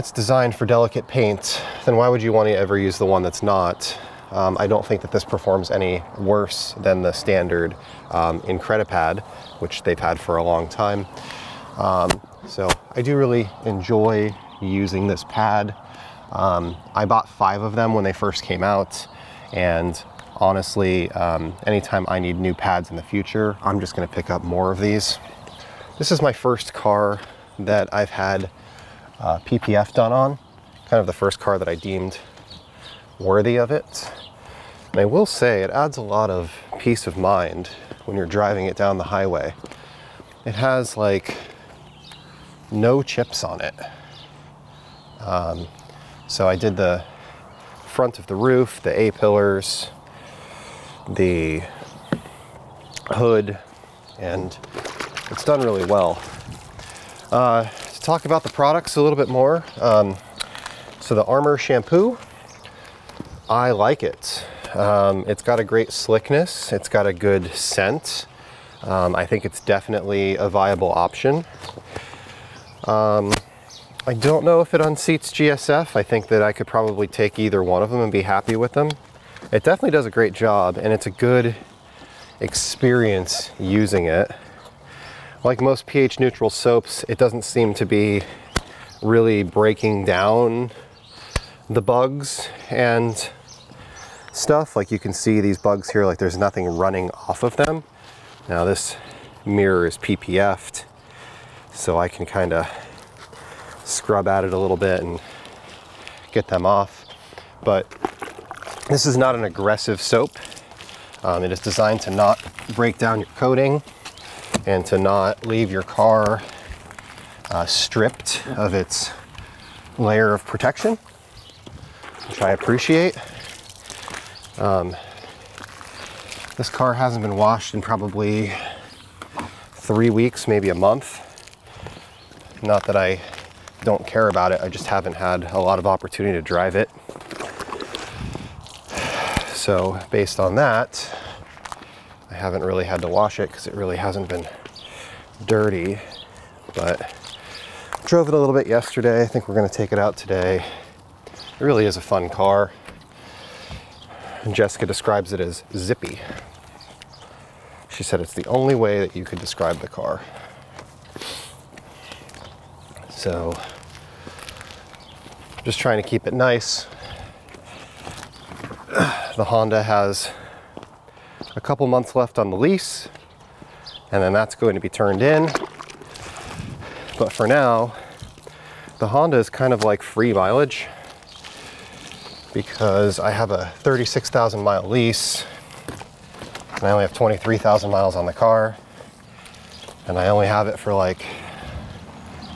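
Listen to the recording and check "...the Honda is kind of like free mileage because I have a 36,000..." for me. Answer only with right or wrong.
right.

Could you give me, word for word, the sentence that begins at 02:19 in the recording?
So, based on that, haven't really had to wash it because it really hasn't been dirty.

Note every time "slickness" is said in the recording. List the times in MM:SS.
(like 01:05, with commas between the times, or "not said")
01:05.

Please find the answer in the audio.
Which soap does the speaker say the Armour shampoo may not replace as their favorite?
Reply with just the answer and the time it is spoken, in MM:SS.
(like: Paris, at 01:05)
GSF, at 01:15.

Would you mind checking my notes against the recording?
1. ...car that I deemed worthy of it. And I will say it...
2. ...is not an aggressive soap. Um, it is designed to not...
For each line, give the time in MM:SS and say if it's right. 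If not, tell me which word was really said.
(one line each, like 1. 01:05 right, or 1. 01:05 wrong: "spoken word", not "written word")
1. 00:31 right
2. 01:49 right.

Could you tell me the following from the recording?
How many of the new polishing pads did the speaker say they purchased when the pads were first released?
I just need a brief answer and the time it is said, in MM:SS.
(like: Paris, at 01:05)
5, at 00:17.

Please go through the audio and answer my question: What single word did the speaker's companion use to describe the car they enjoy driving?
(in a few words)
Zippy.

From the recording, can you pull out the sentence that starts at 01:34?
Like you can see these bugs here, like there's nothing running off of them.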